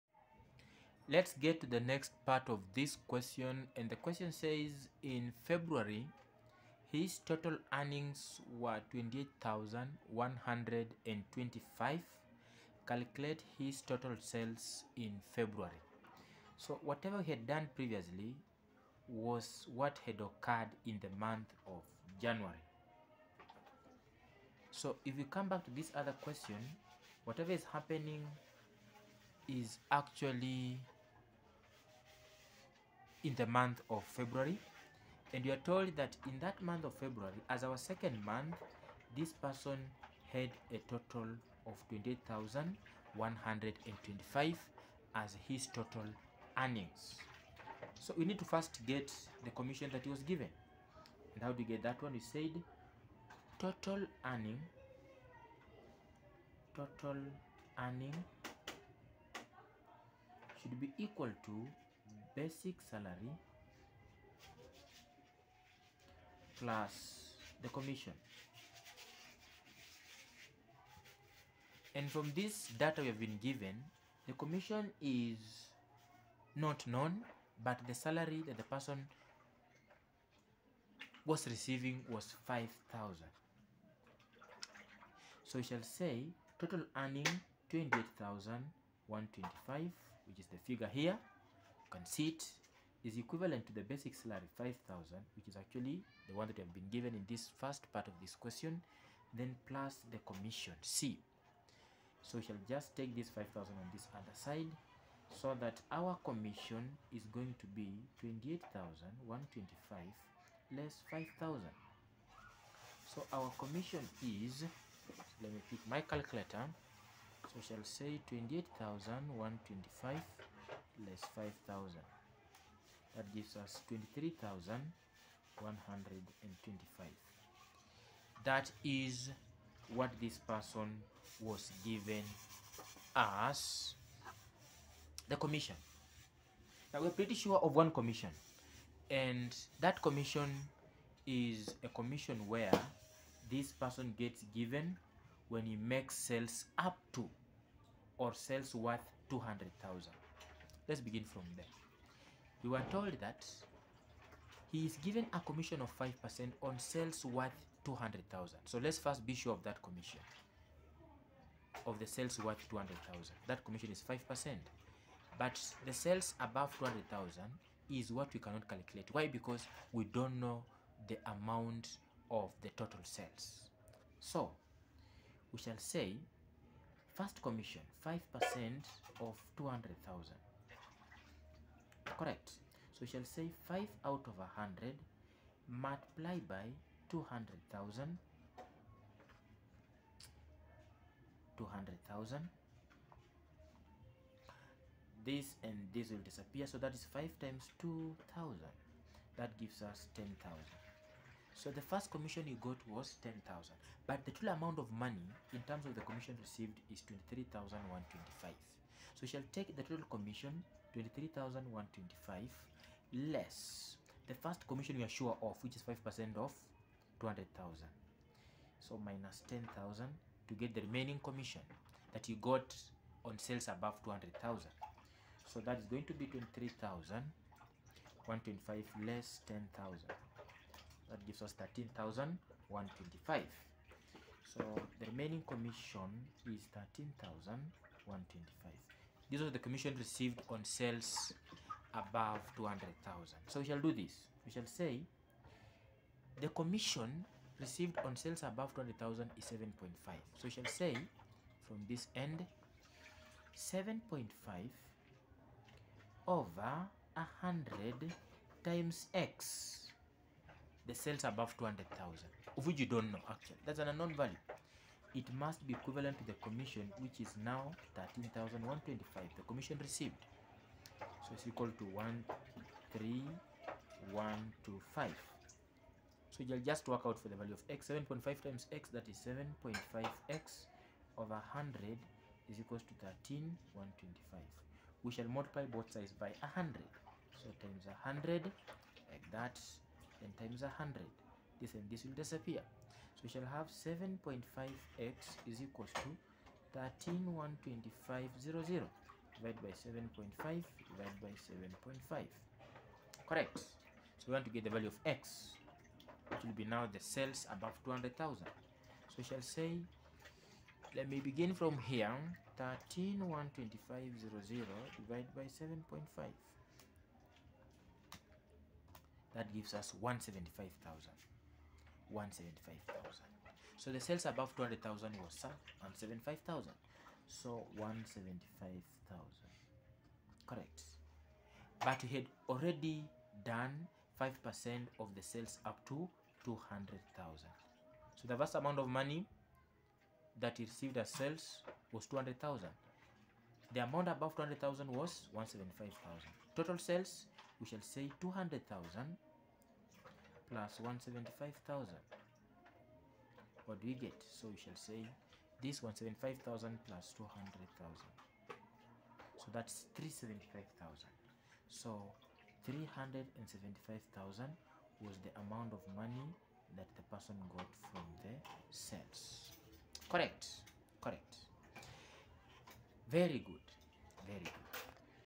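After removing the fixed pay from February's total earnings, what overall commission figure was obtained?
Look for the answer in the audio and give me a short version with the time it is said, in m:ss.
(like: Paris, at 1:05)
23,125, at 2:03.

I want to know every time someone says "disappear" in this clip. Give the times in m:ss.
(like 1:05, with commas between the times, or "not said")
3:16, 4:52.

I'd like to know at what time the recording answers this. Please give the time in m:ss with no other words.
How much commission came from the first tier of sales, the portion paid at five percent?
3:21.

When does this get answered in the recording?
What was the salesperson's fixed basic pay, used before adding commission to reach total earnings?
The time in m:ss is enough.
1:17.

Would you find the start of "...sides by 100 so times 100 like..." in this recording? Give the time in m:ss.
4:45.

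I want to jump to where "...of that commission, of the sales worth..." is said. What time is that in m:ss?
2:39.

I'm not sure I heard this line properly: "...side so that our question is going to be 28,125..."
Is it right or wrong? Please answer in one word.
wrong.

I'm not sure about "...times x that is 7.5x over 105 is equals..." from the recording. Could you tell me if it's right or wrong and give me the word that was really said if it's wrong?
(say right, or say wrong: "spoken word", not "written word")
wrong: "100", not "105".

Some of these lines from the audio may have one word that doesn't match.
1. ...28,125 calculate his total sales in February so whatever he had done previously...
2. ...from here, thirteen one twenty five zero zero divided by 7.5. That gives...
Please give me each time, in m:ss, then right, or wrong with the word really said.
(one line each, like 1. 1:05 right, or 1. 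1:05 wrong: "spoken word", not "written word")
1. 0:08 right
2. 5:11 right.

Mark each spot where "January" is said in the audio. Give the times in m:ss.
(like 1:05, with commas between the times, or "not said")
0:22.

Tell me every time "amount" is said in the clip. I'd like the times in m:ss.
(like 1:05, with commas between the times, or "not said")
2:51, 3:24, 5:38, 5:43, 6:05.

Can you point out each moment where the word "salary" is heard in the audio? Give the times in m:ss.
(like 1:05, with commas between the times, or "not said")
1:02, 1:17, 1:34.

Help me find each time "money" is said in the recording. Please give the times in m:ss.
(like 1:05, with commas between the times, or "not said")
3:24, 5:38, 6:05.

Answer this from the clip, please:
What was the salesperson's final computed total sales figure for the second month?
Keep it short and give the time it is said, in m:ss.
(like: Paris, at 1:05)
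375,000, at 5:59.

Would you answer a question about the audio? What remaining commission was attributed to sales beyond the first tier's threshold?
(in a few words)
13,125.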